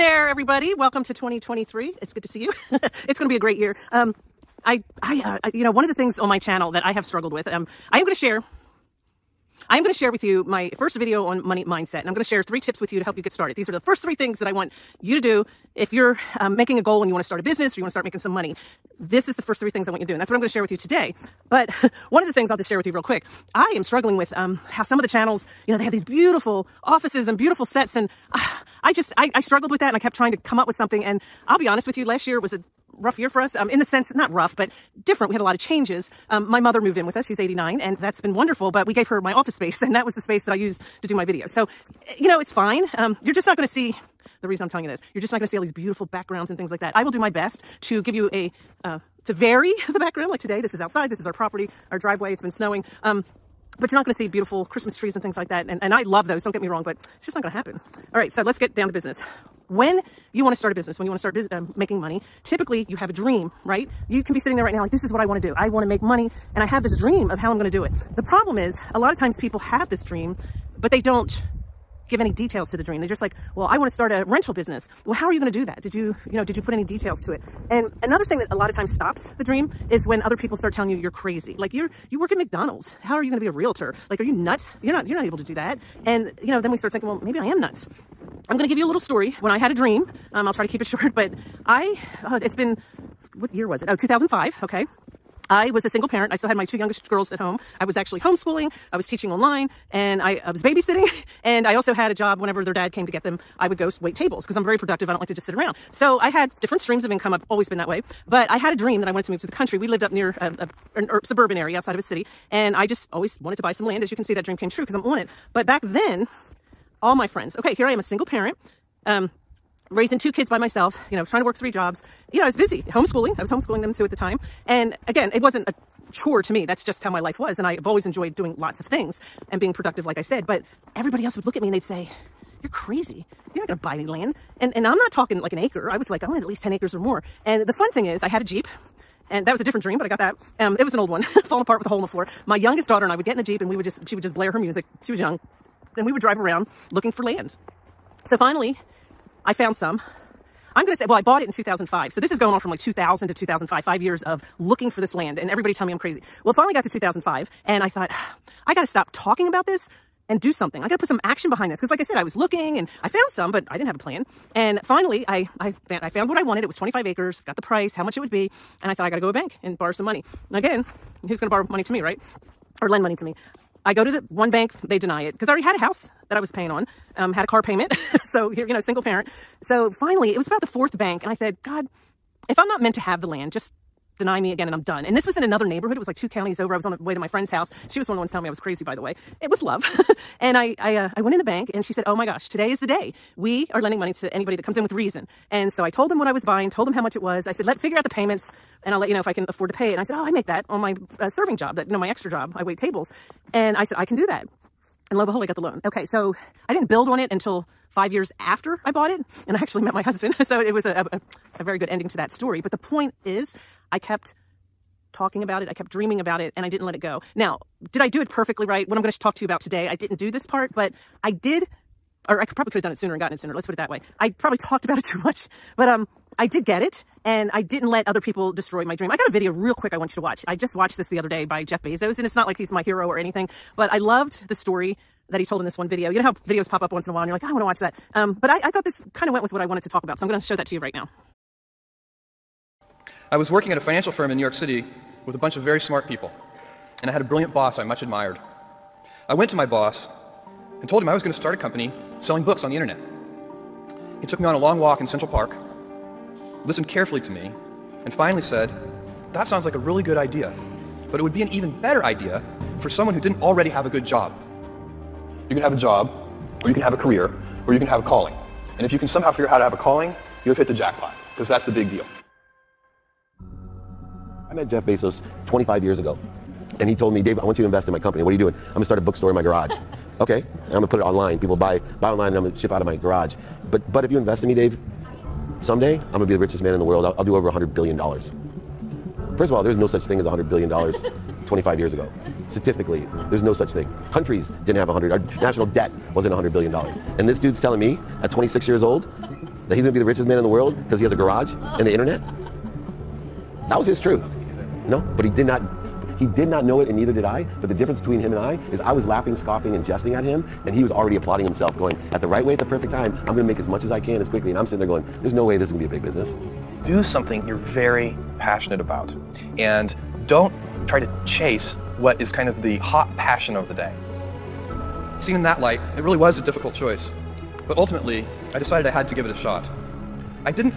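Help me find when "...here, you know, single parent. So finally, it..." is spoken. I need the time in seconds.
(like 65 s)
178 s.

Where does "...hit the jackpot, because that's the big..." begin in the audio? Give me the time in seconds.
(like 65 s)
270 s.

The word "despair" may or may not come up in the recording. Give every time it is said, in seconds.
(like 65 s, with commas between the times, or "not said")
not said.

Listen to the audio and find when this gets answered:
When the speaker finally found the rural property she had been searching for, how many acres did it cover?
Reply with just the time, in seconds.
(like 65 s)
166 s.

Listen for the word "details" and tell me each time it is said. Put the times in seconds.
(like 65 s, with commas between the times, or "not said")
72 s, 76 s.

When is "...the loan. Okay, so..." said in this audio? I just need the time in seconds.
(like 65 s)
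205 s.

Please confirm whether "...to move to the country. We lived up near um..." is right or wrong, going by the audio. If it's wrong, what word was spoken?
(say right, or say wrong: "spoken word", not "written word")
right.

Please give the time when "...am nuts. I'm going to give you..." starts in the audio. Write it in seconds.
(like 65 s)
87 s.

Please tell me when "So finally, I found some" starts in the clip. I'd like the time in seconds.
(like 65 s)
148 s.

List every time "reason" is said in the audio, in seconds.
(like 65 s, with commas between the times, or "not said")
44 s, 194 s.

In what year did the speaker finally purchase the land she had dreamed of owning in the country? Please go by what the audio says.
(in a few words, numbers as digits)
2005.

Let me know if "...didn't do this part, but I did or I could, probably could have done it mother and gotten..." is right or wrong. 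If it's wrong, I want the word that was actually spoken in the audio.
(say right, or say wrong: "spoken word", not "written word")
wrong: "sooner", not "mother".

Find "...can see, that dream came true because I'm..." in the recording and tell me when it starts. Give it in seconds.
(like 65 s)
114 s.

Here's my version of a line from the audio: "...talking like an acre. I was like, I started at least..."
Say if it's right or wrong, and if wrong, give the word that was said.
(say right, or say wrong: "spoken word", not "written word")
wrong: "wanted", not "started".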